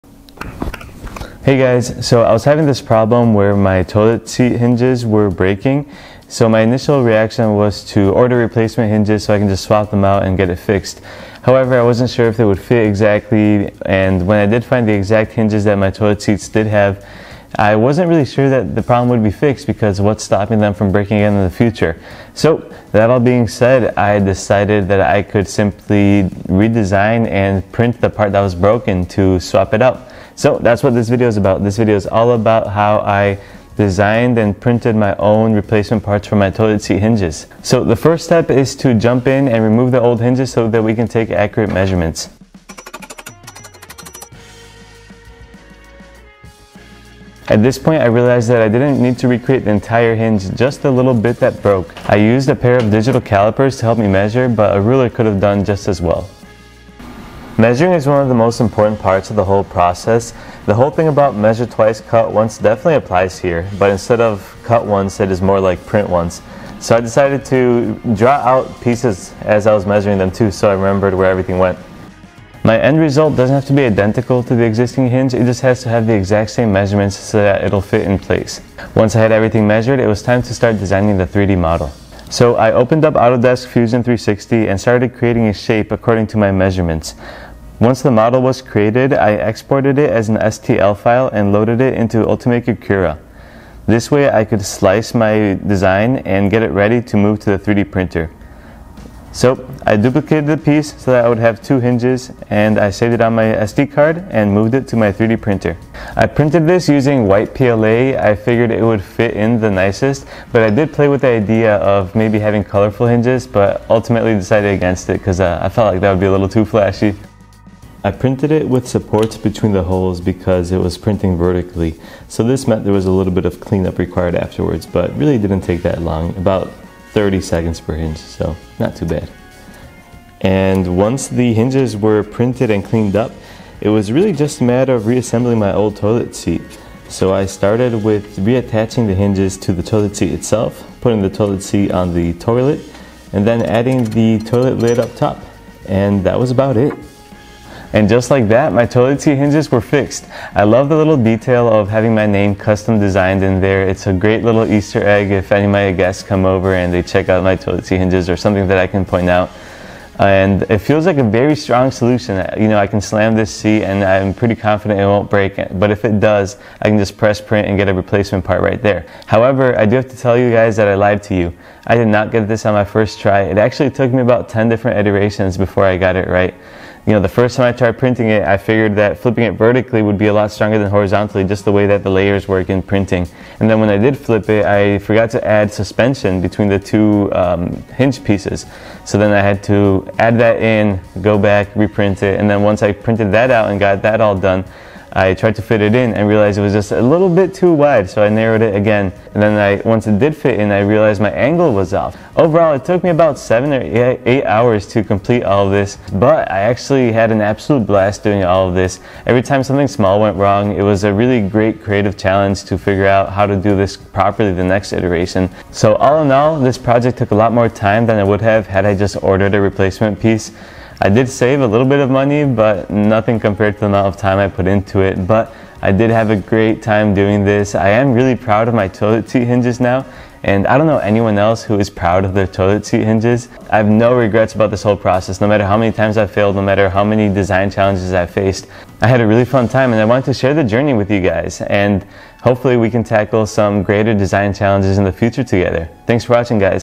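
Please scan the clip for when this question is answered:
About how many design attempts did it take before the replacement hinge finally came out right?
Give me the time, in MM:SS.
02:54.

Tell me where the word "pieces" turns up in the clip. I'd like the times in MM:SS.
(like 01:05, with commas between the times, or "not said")
01:08, 01:40, 03:08, 03:40.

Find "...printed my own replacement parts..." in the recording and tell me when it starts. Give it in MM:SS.
00:34.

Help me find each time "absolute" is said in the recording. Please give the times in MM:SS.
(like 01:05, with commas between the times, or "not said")
03:27.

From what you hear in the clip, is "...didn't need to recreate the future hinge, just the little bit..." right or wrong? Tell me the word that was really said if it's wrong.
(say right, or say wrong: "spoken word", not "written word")
wrong: "entire", not "future".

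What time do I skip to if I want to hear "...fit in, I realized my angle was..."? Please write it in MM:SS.
03:20.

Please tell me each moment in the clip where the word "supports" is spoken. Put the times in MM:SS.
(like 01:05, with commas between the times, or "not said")
01:58.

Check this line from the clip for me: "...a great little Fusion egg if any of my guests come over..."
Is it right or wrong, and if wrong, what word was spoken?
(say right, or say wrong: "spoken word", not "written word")
wrong: "Easter", not "Fusion".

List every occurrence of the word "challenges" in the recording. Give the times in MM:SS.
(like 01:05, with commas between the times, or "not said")
03:32, 03:57, 04:04.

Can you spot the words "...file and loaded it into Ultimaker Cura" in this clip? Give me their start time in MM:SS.
01:30.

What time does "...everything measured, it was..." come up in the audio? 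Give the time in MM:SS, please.
01:19.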